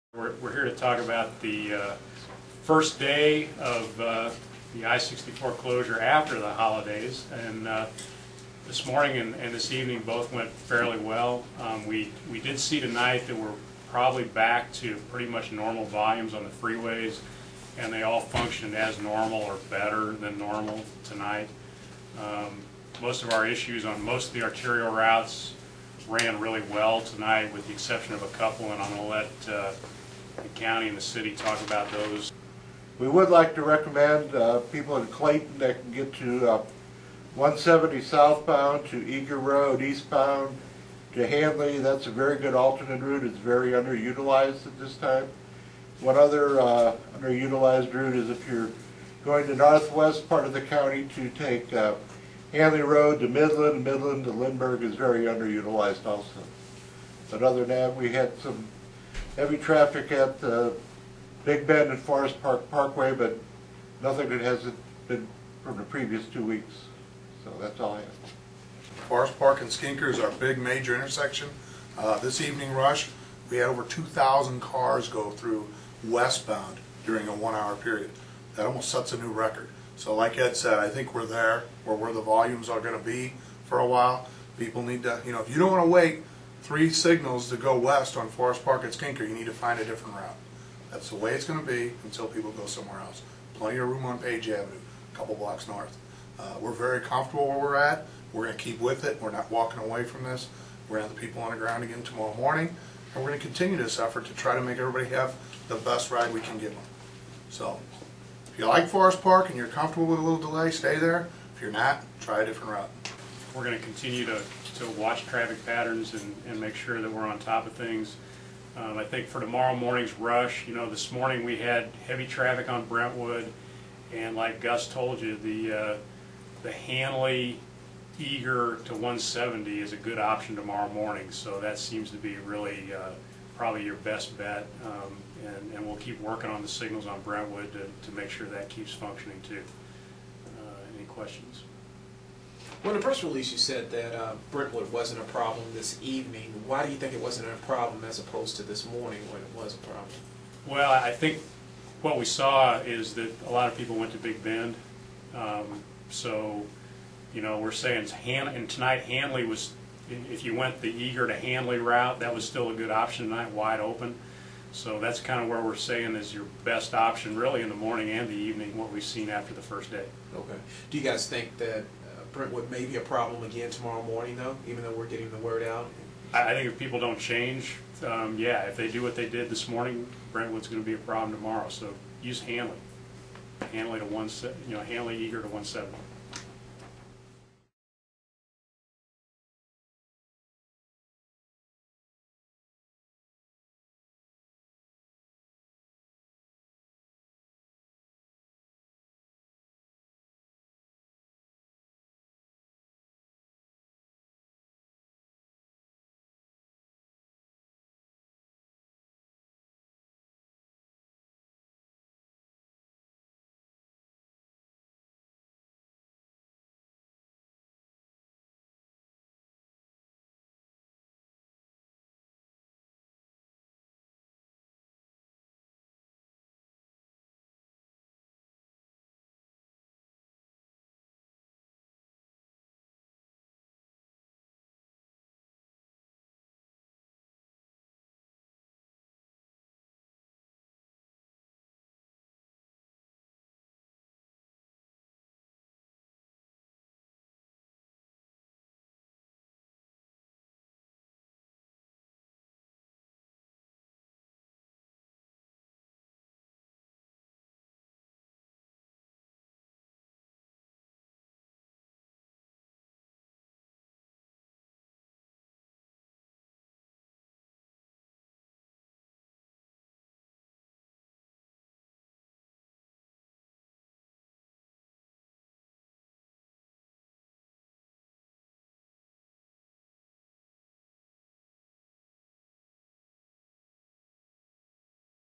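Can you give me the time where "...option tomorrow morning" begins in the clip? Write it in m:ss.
2:10.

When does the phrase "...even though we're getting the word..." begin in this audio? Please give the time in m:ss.
2:54.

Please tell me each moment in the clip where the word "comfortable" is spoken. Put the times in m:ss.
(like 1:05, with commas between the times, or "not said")
1:37, 1:49.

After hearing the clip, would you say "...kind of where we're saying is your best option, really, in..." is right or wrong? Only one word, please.
right.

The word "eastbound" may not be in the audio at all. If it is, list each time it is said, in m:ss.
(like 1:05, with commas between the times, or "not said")
0:39.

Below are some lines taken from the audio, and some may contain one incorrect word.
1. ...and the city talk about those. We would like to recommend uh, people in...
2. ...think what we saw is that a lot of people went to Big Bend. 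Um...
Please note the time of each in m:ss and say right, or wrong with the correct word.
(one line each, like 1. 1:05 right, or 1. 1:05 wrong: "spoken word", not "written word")
1. 0:30 right
2. 2:31 right.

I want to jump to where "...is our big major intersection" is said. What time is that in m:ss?
1:10.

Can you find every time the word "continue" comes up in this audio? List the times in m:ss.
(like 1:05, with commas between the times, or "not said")
1:43, 1:53.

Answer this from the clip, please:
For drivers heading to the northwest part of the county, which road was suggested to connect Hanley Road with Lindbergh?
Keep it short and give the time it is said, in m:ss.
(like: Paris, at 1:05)
Midland, at 0:53.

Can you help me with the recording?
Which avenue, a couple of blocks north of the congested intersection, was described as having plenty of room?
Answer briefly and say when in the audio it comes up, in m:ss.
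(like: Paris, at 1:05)
Page Avenue, at 1:34.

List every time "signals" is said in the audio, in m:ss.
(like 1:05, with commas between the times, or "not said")
1:26, 2:16.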